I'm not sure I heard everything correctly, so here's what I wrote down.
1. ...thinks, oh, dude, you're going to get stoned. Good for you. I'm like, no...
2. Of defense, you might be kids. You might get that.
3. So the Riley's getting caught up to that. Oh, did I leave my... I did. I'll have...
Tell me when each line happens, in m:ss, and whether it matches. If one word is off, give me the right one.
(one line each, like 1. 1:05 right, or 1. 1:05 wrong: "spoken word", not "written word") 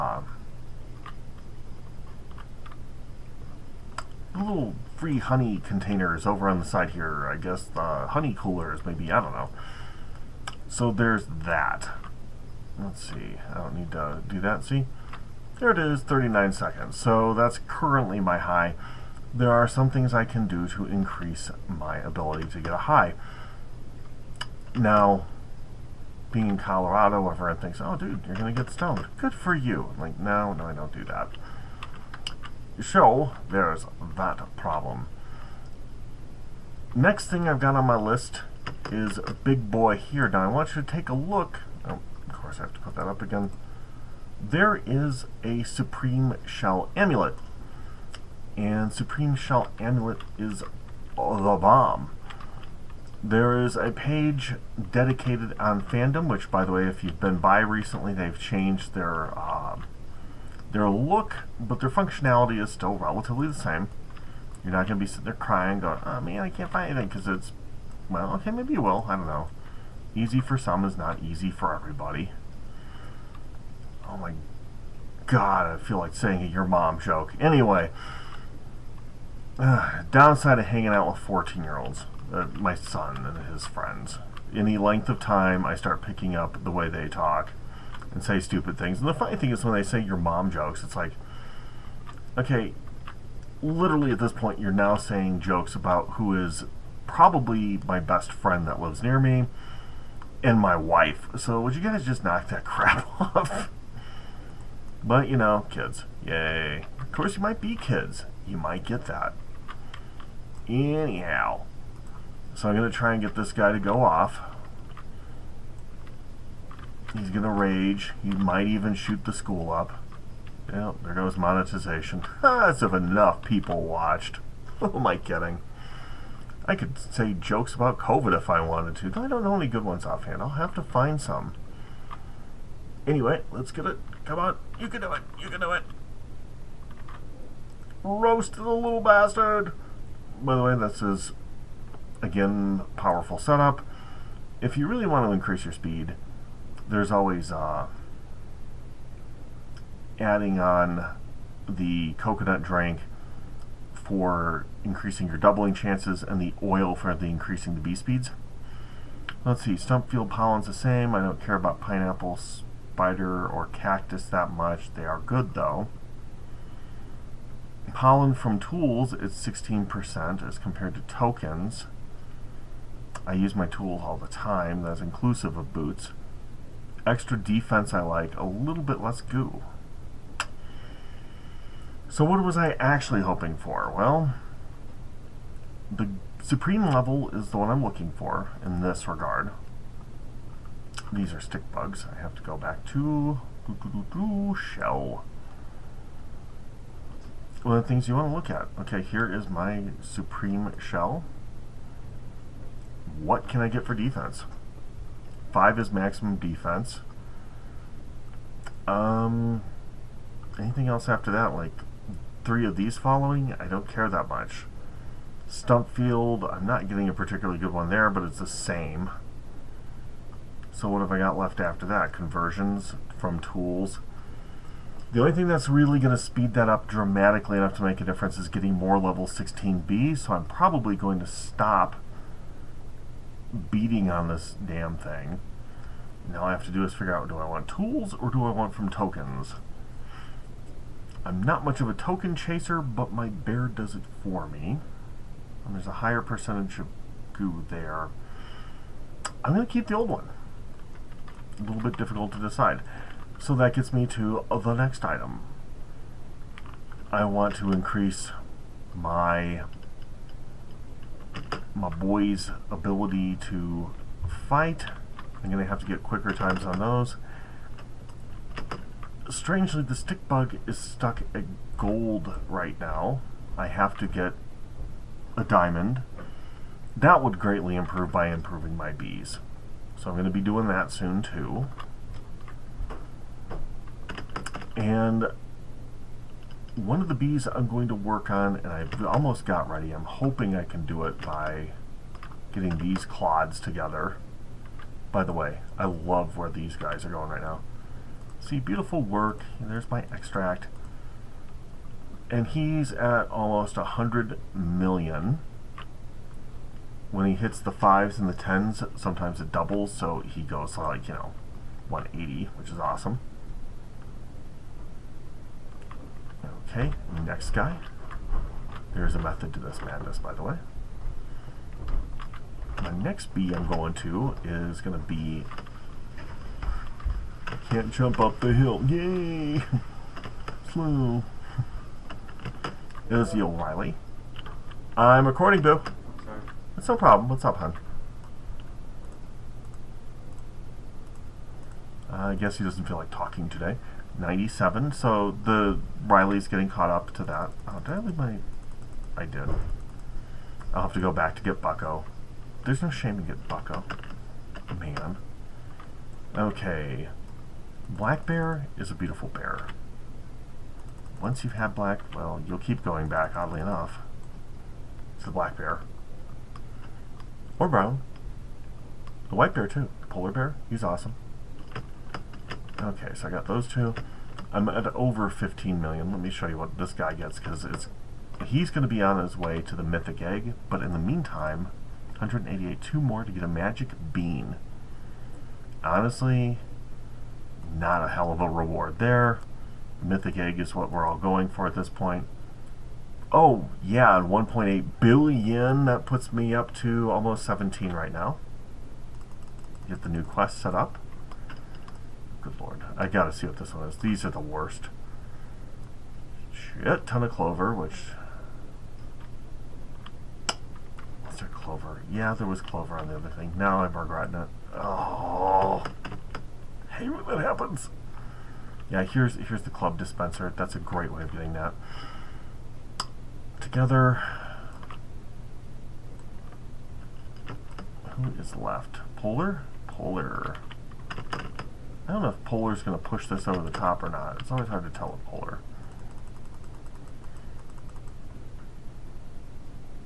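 1. 0:27 right
2. 1:46 wrong: "course", not "defense"
3. 5:44 right.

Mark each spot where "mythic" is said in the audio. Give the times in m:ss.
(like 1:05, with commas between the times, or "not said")
6:19, 6:30.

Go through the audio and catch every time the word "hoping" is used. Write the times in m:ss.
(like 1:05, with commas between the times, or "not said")
3:03, 4:50.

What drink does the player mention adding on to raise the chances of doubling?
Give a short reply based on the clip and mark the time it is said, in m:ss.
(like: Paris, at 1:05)
coconut drink, at 2:32.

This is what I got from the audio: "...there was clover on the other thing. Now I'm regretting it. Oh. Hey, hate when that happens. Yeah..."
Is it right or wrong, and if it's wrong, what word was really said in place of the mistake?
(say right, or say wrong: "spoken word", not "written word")
right.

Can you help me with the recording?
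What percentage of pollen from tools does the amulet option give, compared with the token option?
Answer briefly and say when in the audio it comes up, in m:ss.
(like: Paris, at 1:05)
16%, at 2:49.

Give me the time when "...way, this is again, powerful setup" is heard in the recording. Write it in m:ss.
2:20.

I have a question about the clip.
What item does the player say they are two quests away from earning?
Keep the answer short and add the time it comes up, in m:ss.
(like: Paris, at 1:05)
magic bean, at 6:23.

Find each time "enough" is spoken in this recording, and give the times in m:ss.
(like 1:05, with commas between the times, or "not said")
2:02, 3:47, 6:03.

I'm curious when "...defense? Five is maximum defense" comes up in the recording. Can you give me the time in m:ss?
3:23.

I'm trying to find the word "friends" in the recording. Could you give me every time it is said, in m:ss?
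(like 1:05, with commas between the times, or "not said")
1:23, 1:38.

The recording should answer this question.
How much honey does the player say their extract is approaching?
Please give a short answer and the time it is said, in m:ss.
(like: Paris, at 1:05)
100 million, at 5:03.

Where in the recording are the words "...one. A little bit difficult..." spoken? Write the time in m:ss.
4:10.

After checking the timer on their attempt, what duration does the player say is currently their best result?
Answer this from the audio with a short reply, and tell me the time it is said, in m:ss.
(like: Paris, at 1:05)
39 seconds, at 0:16.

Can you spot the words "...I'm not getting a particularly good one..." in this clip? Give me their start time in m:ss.
3:36.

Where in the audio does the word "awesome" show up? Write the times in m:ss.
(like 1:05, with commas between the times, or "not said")
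5:12, 6:10.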